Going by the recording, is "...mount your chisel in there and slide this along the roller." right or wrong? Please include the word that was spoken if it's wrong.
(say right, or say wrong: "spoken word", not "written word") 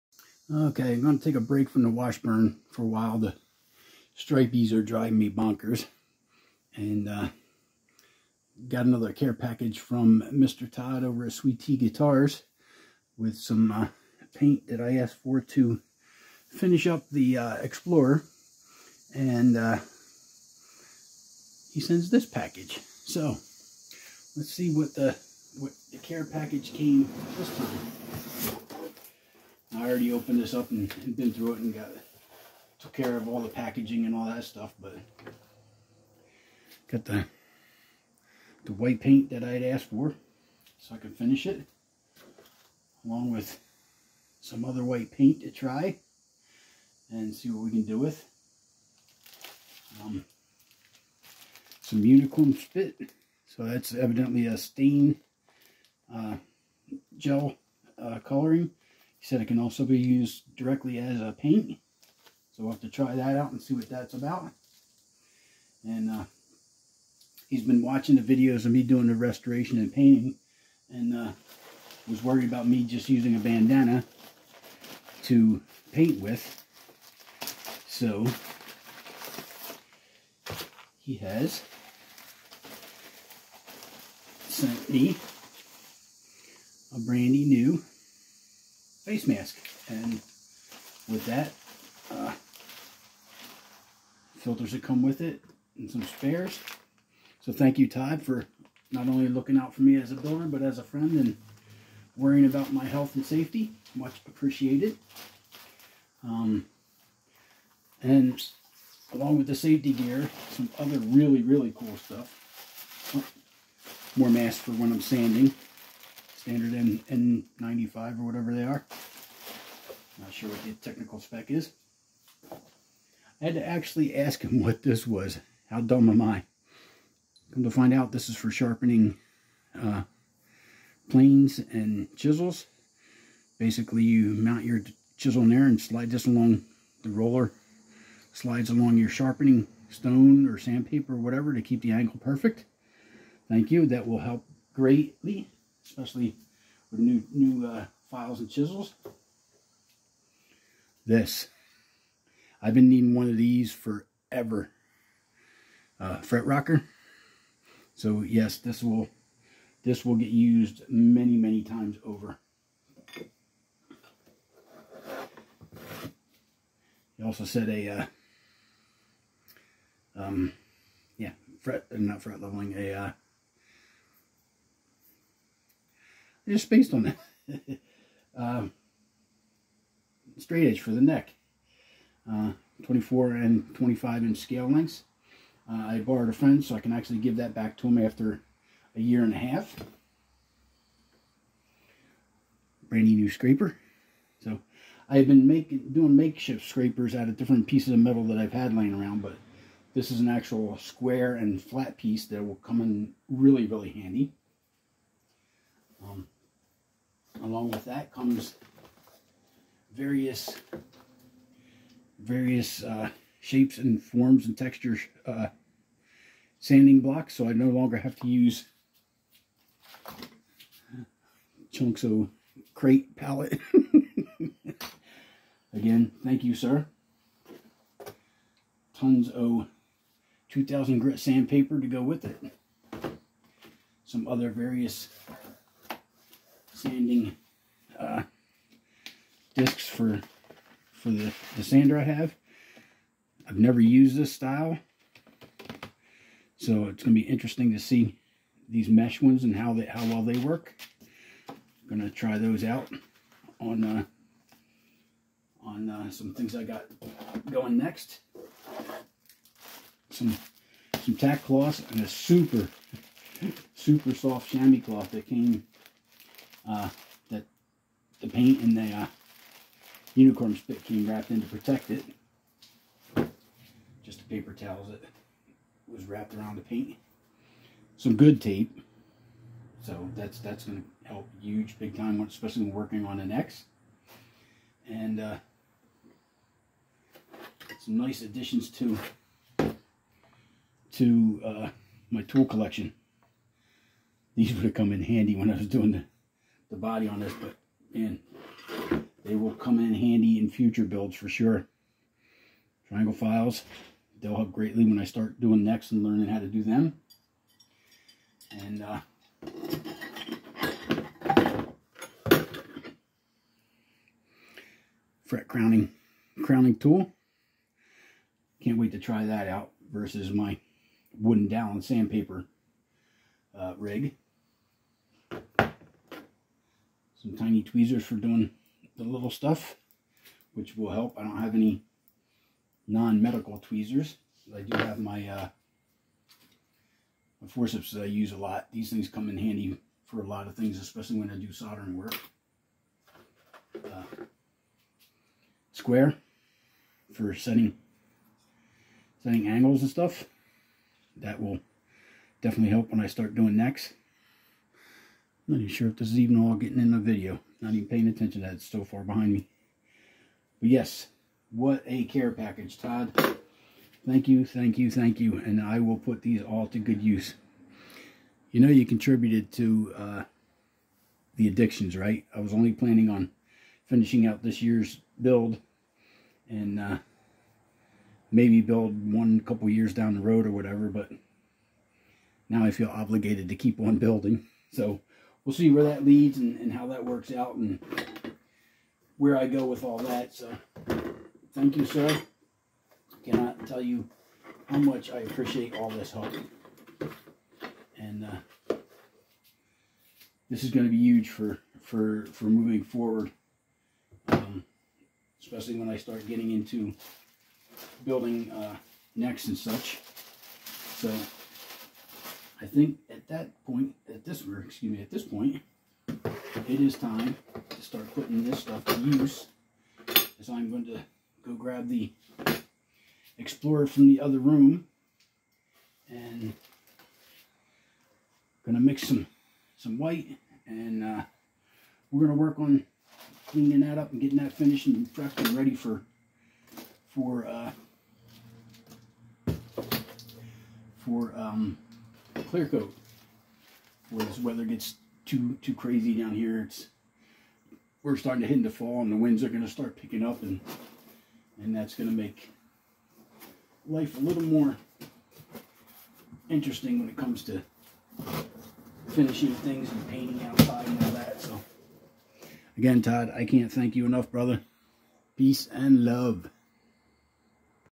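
right.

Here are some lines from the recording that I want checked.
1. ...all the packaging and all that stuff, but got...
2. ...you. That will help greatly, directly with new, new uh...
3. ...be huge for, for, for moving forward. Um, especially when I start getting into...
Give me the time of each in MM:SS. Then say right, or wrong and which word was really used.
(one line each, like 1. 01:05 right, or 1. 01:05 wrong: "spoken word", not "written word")
1. 00:33 right
2. 02:23 wrong: "especially", not "directly"
3. 06:40 right.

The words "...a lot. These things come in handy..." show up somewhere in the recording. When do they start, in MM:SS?
05:38.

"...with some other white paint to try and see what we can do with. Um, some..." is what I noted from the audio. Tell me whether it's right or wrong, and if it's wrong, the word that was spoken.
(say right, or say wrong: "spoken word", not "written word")
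right.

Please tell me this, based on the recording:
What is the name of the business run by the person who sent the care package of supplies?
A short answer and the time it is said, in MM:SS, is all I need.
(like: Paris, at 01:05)
Sweet T Guitars, at 00:11.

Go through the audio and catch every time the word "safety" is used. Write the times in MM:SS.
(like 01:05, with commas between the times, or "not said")
01:43, 01:49.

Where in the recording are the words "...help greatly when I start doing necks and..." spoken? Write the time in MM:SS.
05:04.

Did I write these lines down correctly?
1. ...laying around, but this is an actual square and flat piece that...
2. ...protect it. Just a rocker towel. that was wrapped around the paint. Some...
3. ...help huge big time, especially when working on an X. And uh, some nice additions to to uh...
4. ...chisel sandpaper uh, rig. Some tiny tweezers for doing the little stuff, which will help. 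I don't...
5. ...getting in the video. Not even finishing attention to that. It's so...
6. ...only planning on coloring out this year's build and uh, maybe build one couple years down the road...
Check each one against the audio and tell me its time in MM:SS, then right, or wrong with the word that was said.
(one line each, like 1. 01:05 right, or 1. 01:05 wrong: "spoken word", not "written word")
1. 03:18 right
2. 04:31 wrong: "paper", not "rocker"
3. 04:41 right
4. 05:21 wrong: "dowel", not "chisel"
5. 05:56 wrong: "paying", not "finishing"
6. 06:12 wrong: "finishing", not "coloring".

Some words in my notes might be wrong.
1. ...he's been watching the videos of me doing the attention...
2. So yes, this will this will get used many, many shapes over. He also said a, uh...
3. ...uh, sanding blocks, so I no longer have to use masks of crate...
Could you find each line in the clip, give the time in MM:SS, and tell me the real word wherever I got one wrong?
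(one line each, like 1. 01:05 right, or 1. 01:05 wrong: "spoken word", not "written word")
1. 01:07 wrong: "restoration", not "attention"
2. 02:37 wrong: "times", not "shapes"
3. 03:35 wrong: "chunks", not "masks".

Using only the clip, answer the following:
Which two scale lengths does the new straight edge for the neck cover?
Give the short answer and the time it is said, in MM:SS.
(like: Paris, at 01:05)
24 and 25 inch, at 03:02.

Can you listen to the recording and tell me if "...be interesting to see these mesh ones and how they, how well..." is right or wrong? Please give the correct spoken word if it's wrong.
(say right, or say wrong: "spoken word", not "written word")
right.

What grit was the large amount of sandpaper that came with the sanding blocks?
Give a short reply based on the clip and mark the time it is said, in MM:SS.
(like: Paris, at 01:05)
2000, at 03:50.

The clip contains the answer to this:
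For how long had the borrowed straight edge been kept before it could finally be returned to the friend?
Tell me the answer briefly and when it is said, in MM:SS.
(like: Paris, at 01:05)
A year and a half, at 03:08.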